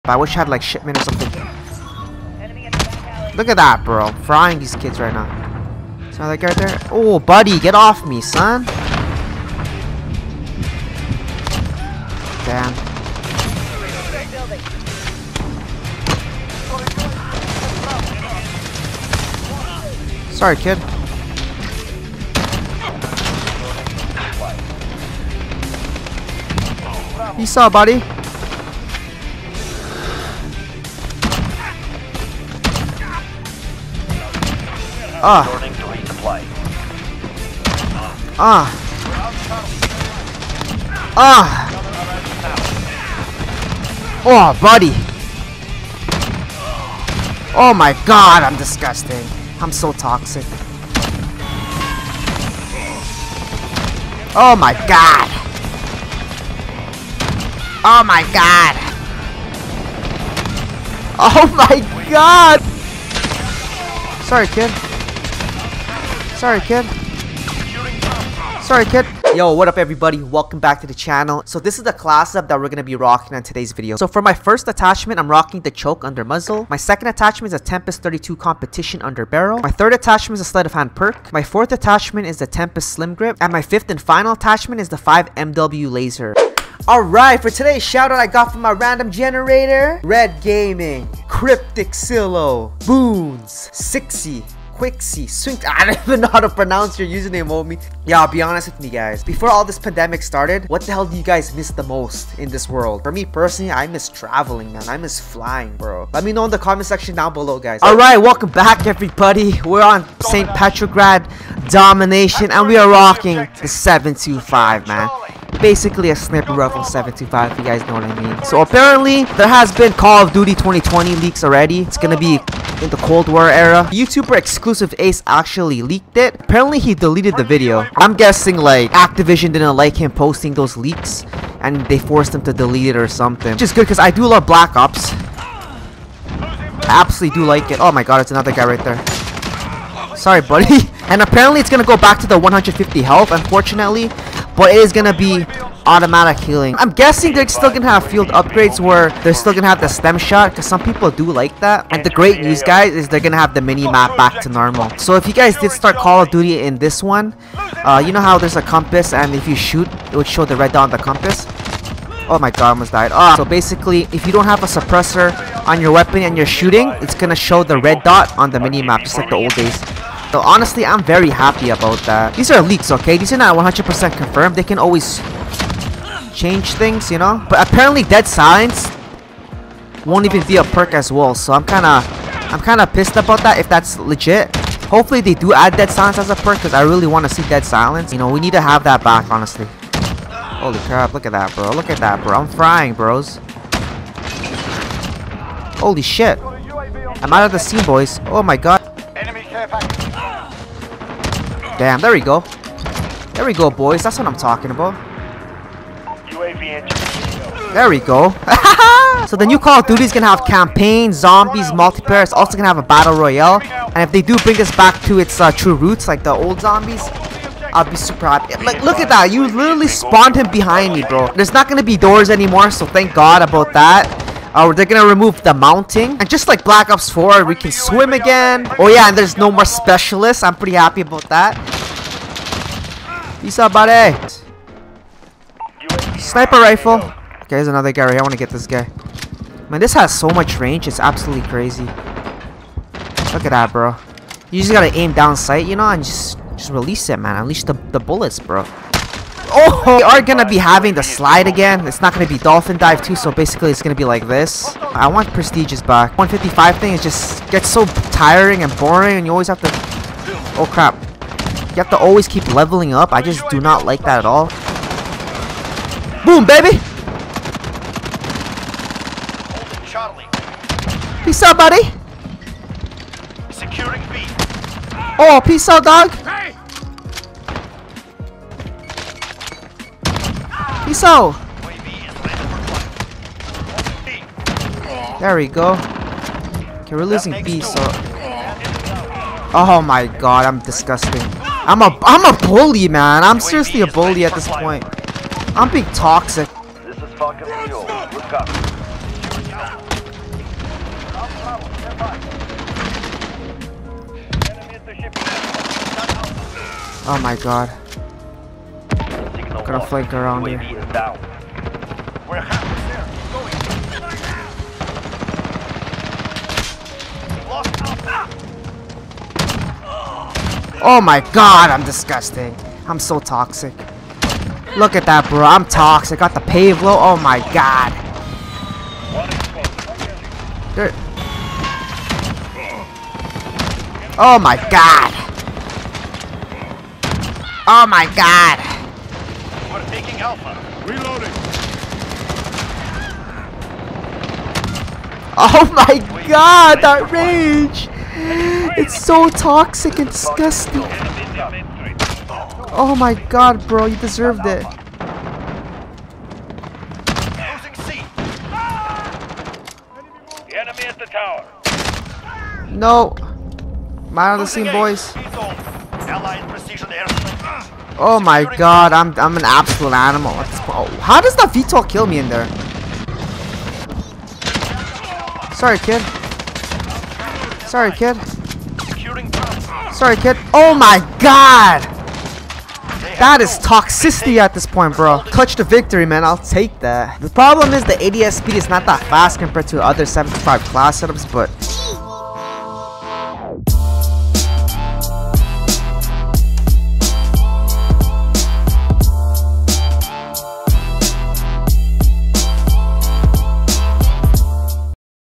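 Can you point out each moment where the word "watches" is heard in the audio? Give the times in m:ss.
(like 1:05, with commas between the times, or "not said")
not said.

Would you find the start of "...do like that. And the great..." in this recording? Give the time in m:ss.
2:31.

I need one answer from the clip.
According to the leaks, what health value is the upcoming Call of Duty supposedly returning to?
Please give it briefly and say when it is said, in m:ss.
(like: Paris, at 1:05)
150, at 2:22.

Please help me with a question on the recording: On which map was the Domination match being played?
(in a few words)
St. Petrograd.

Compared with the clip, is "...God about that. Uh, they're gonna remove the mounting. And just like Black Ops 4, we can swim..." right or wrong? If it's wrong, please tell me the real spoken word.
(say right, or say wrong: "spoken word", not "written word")
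right.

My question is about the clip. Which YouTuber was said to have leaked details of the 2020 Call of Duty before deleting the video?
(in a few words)
Ace.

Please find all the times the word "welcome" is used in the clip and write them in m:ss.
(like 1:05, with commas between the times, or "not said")
1:10, 1:48.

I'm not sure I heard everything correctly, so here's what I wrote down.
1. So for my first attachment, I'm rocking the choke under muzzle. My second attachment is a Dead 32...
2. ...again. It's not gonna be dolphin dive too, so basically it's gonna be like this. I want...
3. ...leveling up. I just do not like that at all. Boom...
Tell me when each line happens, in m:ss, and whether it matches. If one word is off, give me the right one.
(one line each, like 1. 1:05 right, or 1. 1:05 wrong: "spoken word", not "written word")
1. 1:13 wrong: "Tempest", not "Dead"
2. 4:11 right
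3. 4:22 right.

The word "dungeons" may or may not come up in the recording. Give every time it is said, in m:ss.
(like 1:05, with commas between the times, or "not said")
not said.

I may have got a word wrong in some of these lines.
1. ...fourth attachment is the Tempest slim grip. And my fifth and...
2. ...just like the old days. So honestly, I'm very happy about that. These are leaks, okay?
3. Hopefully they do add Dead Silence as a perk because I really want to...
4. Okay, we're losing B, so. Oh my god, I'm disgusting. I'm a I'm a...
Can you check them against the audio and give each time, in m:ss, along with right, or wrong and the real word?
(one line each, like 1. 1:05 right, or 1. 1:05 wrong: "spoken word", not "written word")
1. 1:21 right
2. 2:49 right
3. 3:04 right
4. 4:45 right.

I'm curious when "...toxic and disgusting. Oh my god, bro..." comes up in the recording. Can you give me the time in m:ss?
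5:49.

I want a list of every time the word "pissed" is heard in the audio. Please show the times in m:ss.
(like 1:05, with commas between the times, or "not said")
3:02.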